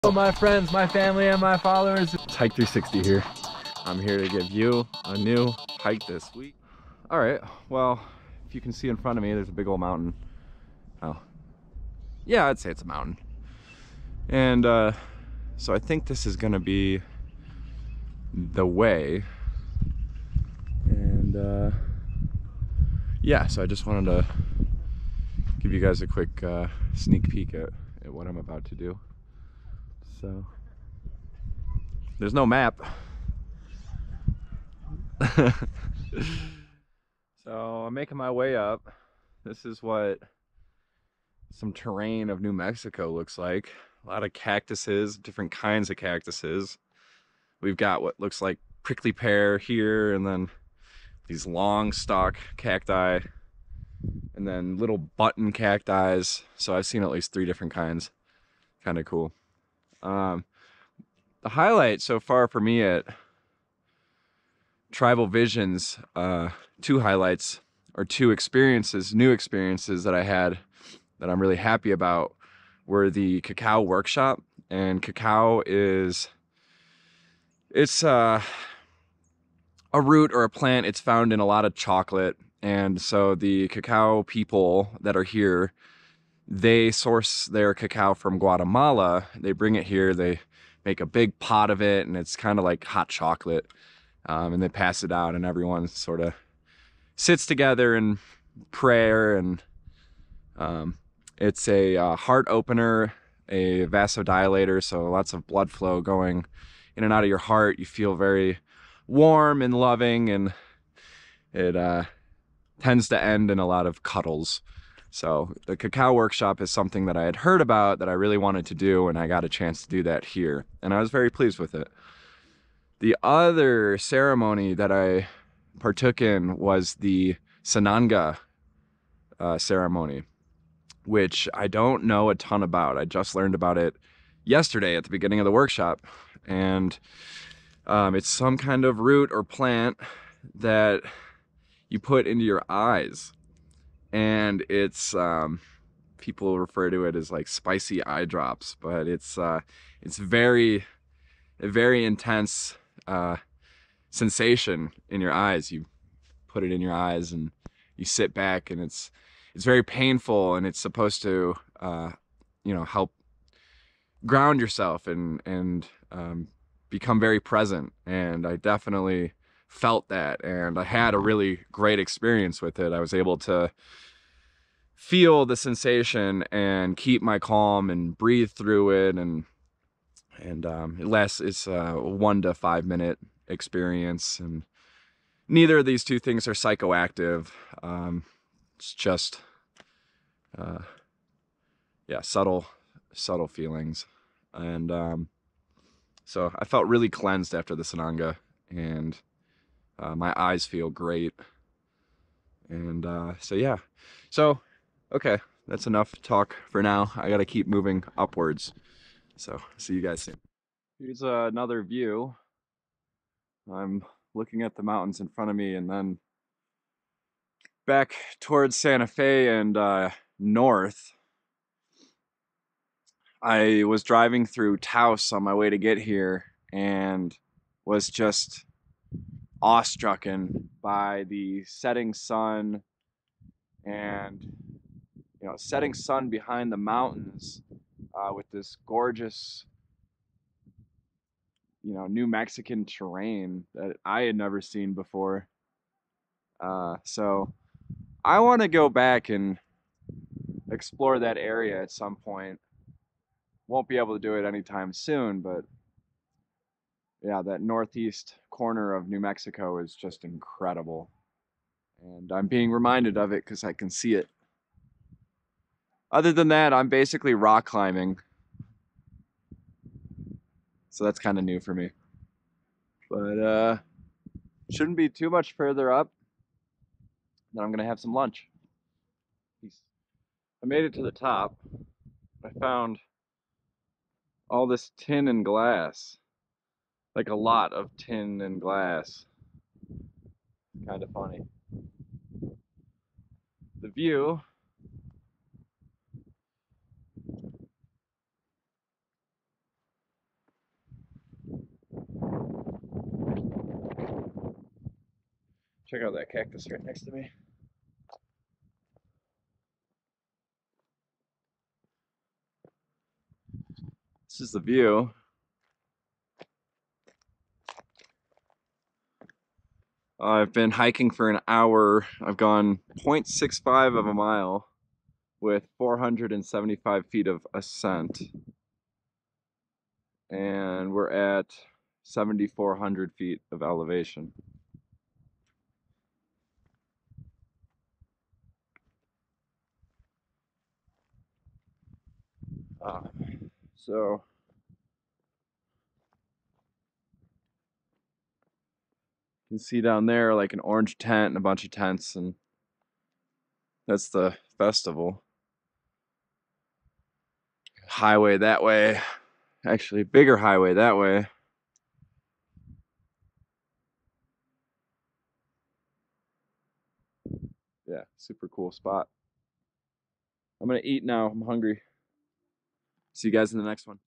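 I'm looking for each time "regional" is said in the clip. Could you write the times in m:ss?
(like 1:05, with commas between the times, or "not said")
not said.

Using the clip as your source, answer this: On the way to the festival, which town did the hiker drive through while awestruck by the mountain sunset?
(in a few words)
Taos.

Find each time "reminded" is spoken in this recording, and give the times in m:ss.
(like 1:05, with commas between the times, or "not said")
4:22.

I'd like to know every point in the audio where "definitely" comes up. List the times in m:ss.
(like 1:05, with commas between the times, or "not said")
2:48.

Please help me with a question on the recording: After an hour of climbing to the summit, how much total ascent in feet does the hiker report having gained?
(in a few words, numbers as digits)
475 feet.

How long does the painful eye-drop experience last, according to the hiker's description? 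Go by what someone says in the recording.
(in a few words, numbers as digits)
1 to 5 minutes.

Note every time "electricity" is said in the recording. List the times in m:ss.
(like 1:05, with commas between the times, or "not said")
not said.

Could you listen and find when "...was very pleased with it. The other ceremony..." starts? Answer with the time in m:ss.
2:01.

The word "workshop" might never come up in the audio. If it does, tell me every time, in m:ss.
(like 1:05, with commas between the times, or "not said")
1:13, 1:56, 2:15.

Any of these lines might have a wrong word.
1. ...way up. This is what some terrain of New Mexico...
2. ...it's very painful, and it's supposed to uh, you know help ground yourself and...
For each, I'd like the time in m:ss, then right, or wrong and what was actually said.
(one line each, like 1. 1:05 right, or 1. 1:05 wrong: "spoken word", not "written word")
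1. 0:38 right
2. 2:39 right.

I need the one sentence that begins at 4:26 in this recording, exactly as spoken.
Other than that, I'm basically rock climbing.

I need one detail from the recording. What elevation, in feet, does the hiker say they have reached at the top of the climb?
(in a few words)
7,400 feet.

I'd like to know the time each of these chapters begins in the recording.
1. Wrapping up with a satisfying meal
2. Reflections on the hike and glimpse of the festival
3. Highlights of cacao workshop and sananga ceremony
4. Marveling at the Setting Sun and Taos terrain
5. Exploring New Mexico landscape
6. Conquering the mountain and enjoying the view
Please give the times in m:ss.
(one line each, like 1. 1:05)
1. 5:49
2. 4:17
3. 1:00
4. 3:05
5. 0:23
6. 2:02.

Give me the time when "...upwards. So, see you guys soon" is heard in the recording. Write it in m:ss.
3:28.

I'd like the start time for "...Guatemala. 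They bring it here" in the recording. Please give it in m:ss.
1:28.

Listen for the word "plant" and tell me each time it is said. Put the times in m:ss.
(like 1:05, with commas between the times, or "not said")
1:20, 2:19.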